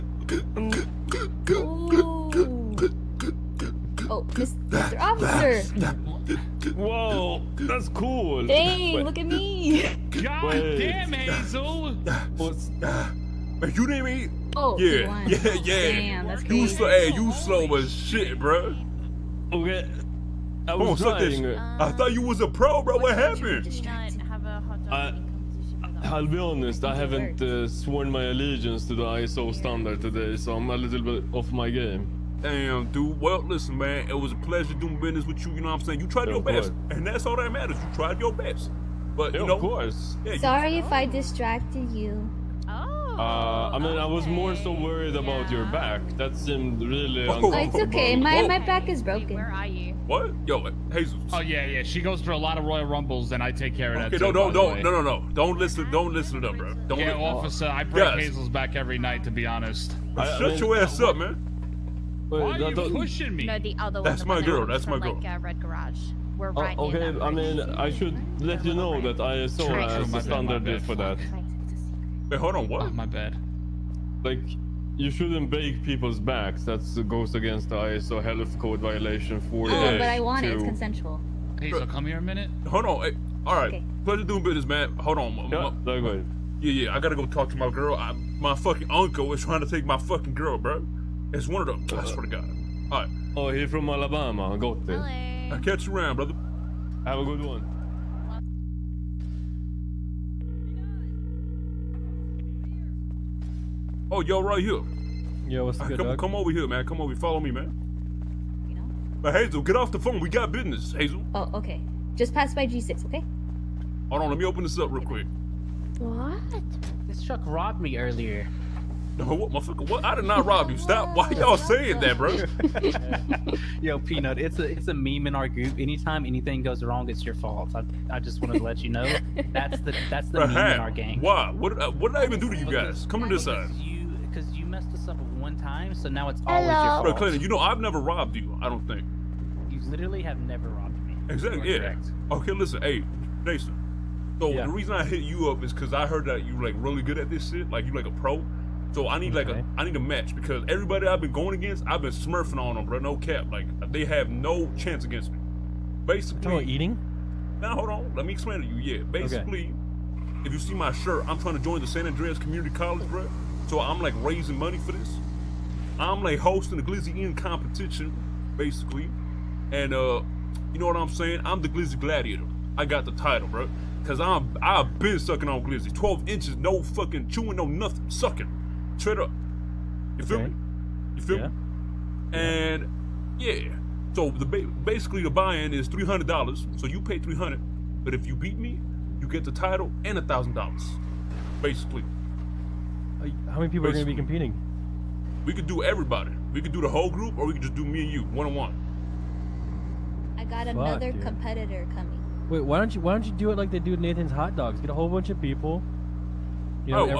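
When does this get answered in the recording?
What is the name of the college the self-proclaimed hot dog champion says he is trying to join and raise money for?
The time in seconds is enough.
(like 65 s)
161 s.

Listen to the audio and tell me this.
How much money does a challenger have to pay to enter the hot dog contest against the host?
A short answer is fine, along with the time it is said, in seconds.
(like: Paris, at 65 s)
$300, at 185 s.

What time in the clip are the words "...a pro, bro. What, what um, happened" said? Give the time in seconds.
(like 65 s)
22 s.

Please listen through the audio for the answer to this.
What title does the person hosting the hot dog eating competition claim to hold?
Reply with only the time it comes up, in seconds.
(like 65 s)
171 s.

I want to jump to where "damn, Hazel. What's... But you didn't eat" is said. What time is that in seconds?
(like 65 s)
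10 s.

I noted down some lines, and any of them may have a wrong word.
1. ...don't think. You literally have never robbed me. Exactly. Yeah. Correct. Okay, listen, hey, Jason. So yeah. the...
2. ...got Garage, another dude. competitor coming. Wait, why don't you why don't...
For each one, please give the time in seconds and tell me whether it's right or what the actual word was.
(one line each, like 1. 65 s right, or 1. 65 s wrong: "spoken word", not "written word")
1. 138 s right
2. 200 s wrong: "Fuck", not "Garage".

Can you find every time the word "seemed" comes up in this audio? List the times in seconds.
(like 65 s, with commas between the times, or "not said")
46 s.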